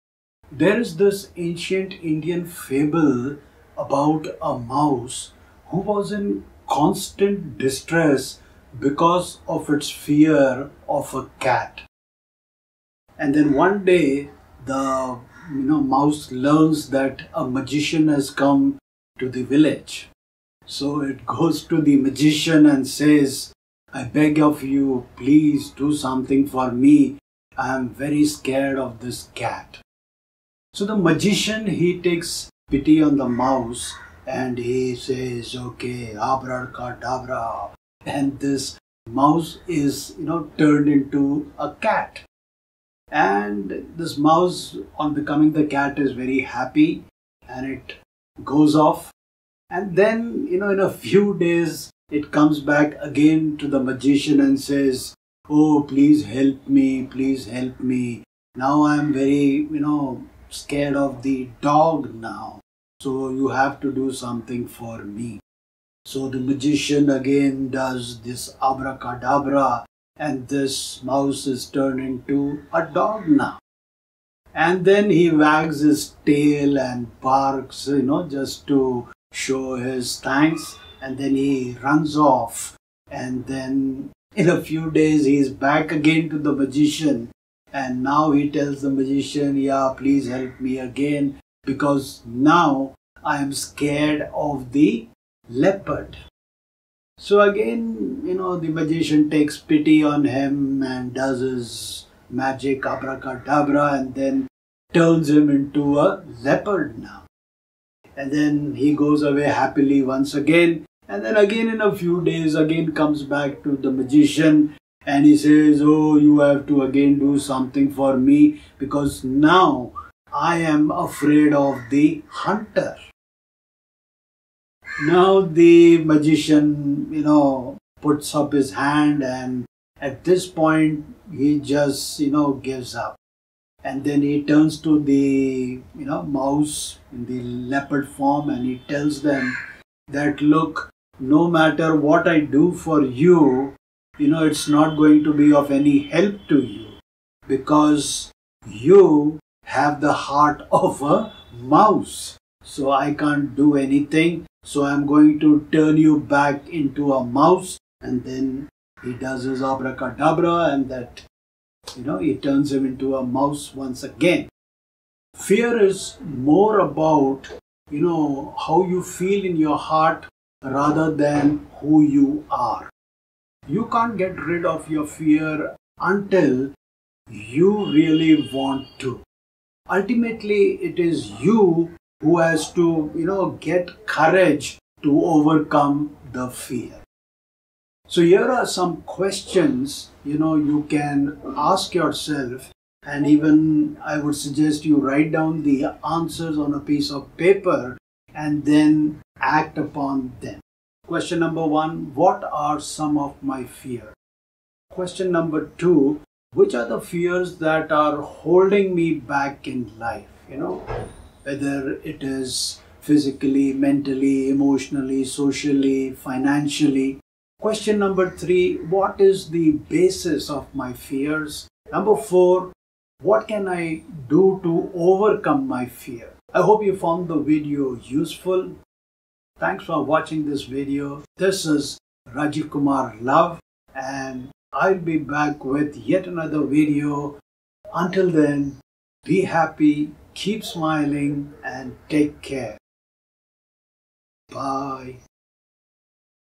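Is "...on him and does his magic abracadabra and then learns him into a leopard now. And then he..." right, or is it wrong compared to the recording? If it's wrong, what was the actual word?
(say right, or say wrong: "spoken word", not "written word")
wrong: "turns", not "learns".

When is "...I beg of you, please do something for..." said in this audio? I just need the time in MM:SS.
00:23.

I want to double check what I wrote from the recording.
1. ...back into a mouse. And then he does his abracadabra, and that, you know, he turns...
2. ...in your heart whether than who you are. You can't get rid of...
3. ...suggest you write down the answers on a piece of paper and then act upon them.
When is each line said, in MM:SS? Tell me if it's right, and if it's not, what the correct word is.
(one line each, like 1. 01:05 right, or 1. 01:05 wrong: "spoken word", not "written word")
1. 02:36 right
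2. 02:49 wrong: "rather", not "whether"
3. 03:14 right.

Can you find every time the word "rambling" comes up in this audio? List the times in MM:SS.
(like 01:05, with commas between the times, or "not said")
not said.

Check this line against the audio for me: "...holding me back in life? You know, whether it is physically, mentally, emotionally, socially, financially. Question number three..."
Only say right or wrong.
right.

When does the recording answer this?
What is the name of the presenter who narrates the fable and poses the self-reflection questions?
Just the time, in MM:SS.
03:52.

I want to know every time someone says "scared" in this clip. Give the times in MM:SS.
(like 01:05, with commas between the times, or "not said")
00:28, 01:00, 01:33.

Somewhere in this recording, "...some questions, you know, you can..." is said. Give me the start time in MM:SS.
03:08.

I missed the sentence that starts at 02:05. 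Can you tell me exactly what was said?
Now the magician, you know, puts up his hand and at this point he just, you know, gives up.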